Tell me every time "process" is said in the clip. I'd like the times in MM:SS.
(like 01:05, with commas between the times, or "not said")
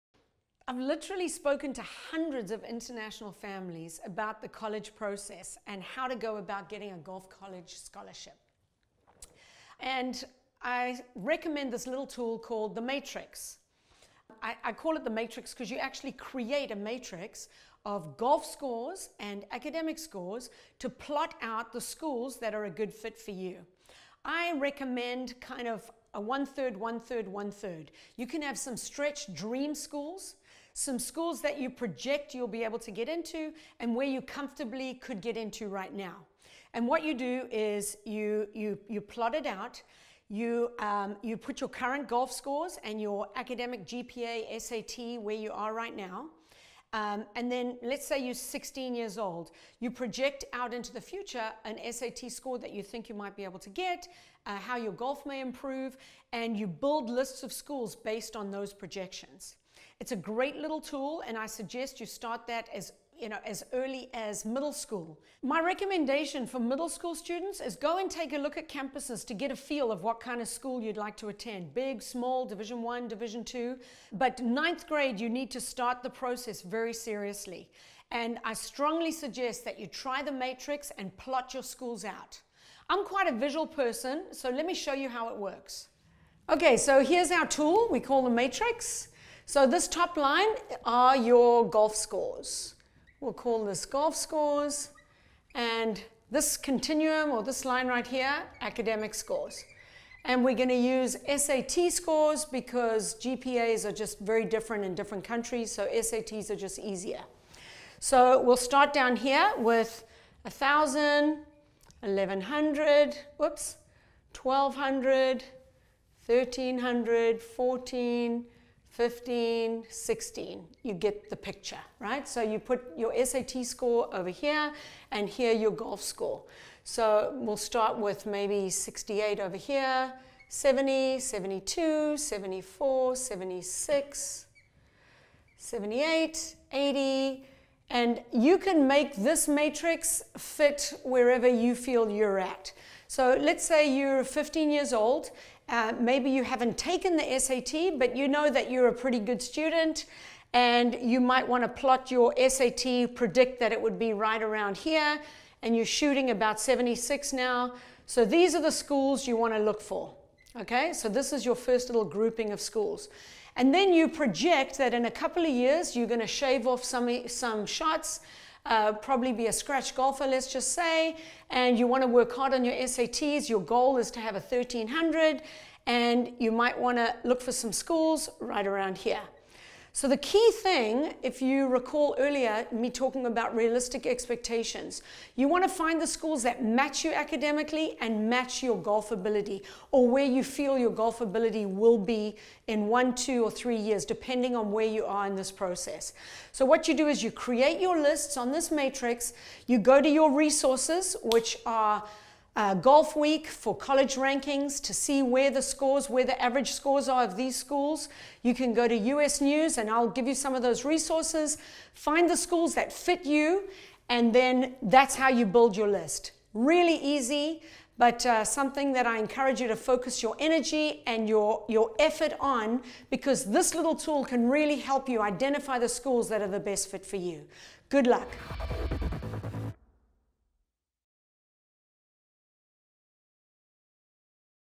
00:04, 01:16, 03:15.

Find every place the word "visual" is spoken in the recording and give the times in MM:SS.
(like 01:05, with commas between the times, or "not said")
01:23.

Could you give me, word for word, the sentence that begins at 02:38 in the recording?
So these are the schools you want to look for.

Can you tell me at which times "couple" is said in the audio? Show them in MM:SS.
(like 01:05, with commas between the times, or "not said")
02:45.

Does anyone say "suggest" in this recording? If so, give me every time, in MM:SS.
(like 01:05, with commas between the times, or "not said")
01:01, 01:19.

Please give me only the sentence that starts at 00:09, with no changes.
And I recommend this little tool called the Matrix.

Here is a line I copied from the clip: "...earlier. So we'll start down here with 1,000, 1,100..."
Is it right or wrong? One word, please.
wrong.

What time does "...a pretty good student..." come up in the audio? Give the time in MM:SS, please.
02:28.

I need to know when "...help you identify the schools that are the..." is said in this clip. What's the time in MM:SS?
03:44.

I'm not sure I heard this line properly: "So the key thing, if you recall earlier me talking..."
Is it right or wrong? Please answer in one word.
right.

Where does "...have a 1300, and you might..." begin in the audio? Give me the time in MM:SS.
02:54.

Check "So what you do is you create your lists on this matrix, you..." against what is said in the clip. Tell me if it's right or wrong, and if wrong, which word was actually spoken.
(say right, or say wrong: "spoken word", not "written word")
right.